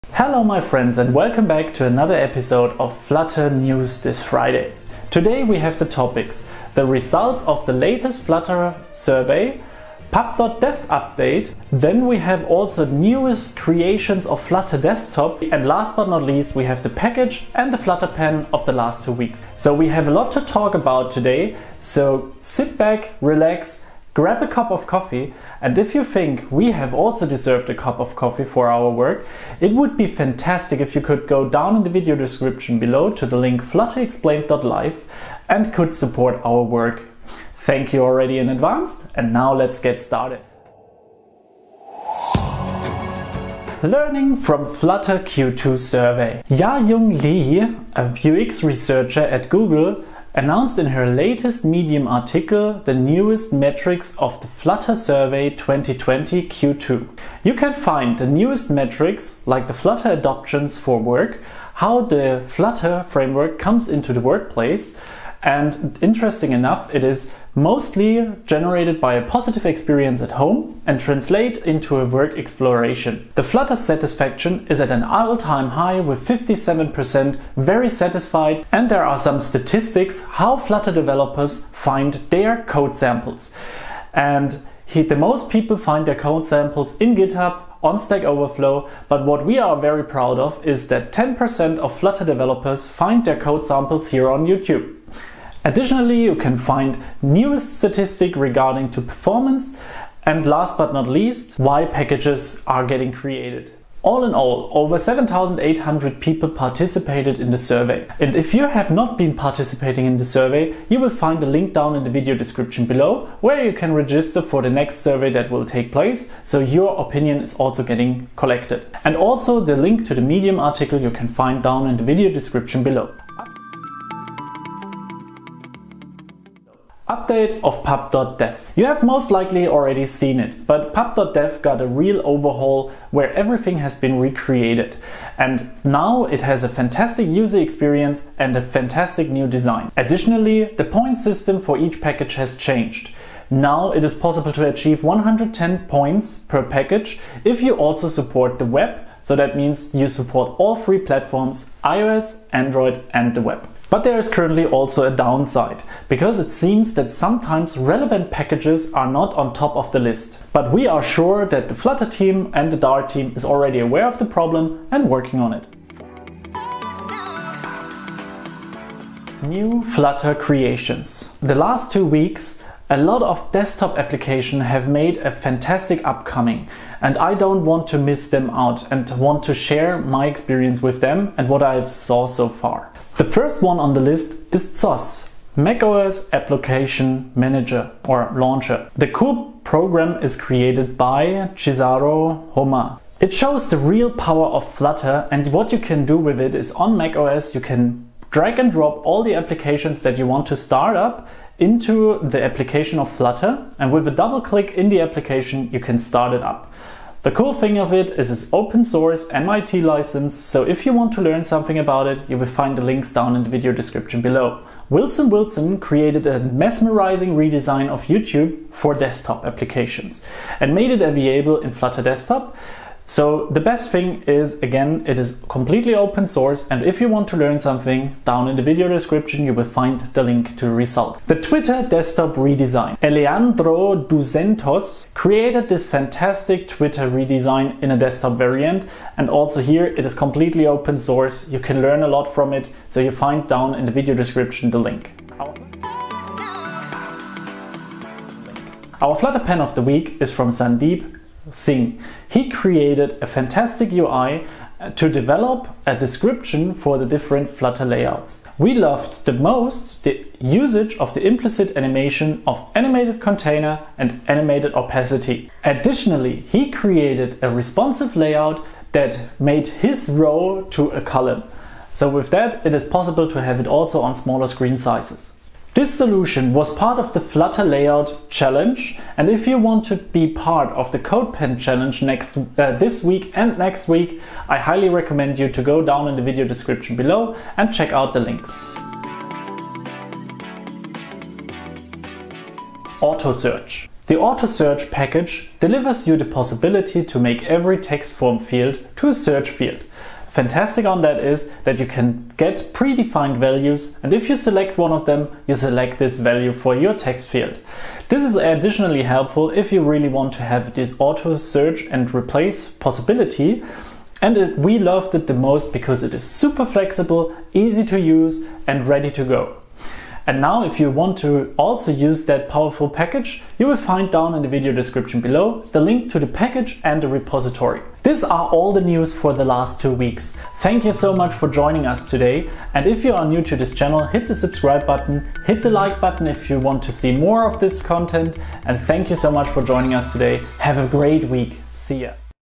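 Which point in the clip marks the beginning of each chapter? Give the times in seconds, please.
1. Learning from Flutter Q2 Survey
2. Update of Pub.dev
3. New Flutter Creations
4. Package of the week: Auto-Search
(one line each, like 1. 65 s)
1. 43 s
2. 120 s
3. 165 s
4. 240 s.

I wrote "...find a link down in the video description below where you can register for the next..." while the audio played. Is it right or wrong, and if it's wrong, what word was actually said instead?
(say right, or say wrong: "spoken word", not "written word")
right.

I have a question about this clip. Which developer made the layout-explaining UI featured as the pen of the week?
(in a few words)
Sahdeep Singh.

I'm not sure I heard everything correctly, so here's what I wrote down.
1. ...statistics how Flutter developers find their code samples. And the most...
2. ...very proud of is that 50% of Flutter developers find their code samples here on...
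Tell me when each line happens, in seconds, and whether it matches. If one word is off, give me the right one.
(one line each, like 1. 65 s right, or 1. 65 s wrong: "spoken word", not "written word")
1. 79 s right
2. 89 s wrong: "10", not "50".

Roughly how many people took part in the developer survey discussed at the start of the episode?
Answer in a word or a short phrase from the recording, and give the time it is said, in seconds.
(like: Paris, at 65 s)
7,800, at 104 s.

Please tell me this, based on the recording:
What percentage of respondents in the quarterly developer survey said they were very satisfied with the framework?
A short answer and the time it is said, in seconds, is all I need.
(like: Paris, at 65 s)
57%, at 76 s.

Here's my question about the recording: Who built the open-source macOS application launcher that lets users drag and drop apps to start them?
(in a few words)
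Chiziaruhoma.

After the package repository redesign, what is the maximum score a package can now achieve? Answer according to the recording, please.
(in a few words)
110.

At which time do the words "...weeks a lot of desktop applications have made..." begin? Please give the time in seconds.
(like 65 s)
172 s.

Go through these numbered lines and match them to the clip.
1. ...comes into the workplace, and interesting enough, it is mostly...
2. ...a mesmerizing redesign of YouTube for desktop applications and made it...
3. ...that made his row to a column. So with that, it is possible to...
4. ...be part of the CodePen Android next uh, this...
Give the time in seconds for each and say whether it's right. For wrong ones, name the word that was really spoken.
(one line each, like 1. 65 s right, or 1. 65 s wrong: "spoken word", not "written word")
1. 63 s right
2. 216 s right
3. 268 s right
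4. 279 s wrong: "Challenge", not "Android".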